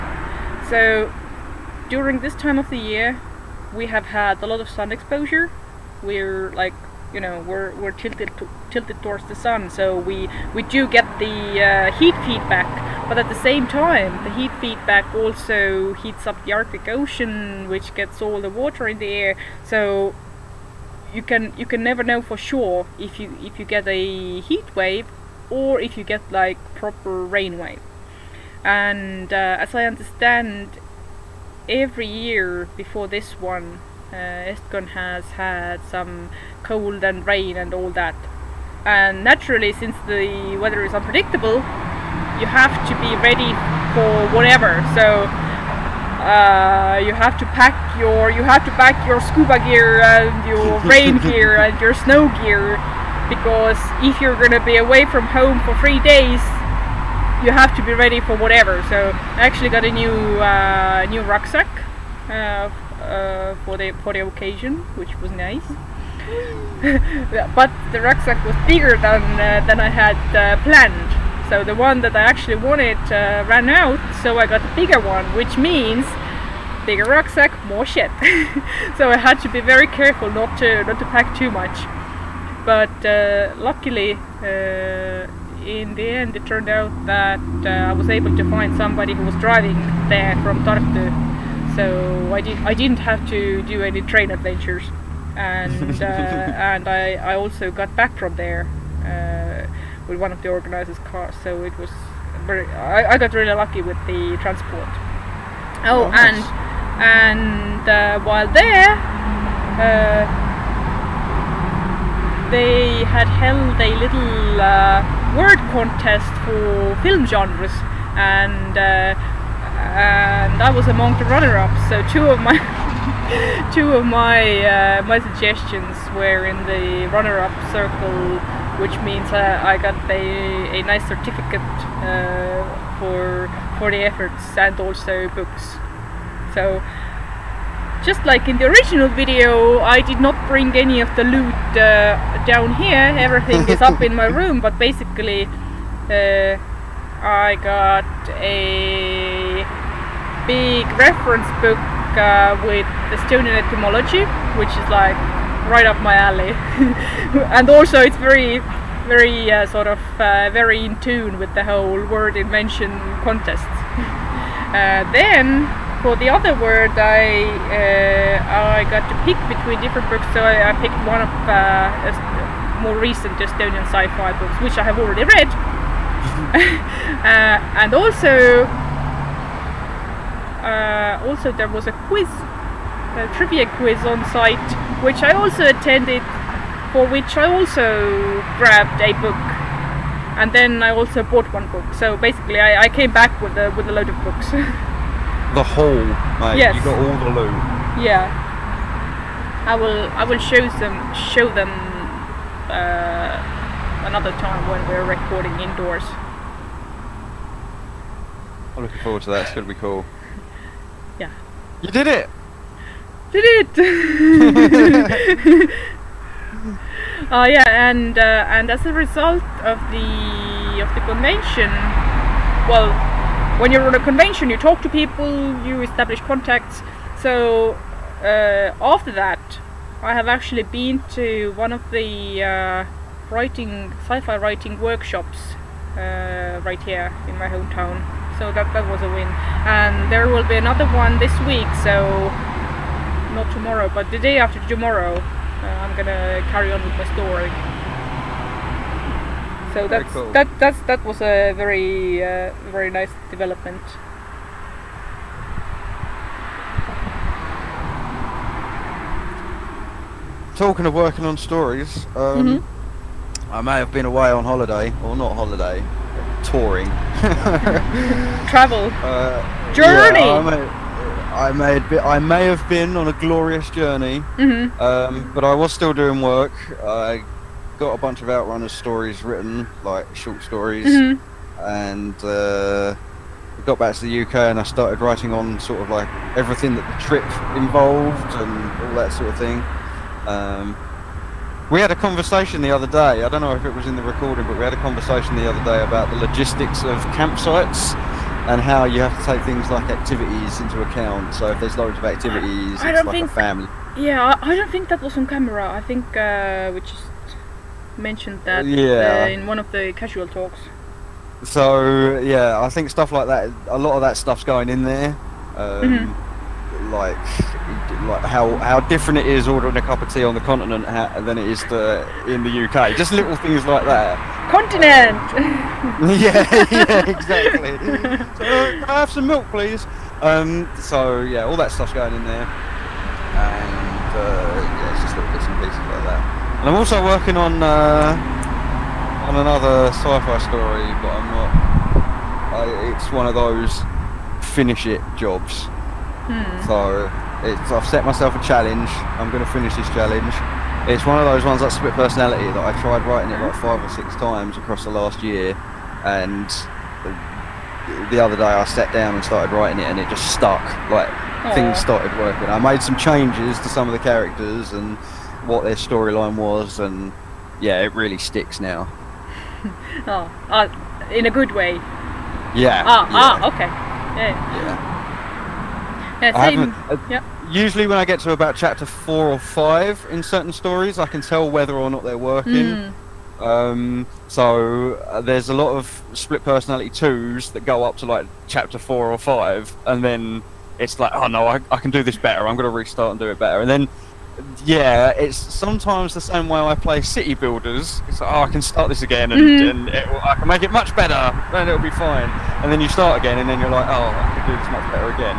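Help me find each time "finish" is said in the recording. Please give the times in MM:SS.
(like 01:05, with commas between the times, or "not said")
05:44, 05:49.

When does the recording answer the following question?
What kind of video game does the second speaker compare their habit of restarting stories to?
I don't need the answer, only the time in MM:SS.
06:37.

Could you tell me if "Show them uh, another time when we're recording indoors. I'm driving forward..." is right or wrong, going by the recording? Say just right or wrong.
wrong.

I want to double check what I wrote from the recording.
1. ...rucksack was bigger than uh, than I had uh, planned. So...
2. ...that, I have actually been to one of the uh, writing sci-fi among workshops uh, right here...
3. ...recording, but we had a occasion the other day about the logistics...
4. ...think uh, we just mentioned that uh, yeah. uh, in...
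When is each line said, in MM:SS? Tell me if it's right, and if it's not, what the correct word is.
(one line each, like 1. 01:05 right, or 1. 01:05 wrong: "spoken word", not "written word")
1. 01:08 right
2. 03:49 wrong: "writing", not "among"
3. 04:54 wrong: "conversation", not "occasion"
4. 05:05 right.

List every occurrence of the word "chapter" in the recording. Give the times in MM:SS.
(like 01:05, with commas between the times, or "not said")
06:18, 06:28.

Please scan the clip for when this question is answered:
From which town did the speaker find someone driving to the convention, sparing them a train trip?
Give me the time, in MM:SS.
01:30.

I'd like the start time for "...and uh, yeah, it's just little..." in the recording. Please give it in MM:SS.
05:32.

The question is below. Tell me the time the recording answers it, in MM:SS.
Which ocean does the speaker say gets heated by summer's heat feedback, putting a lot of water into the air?
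00:16.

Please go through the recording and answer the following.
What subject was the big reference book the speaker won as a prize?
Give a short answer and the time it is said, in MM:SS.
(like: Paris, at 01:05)
Estonian etymology, at 02:33.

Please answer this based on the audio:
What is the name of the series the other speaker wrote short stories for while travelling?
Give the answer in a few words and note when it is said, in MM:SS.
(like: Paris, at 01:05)
Outrunners, at 04:38.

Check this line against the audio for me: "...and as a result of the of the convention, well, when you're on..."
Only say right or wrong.
right.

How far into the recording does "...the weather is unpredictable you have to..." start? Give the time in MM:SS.
00:40.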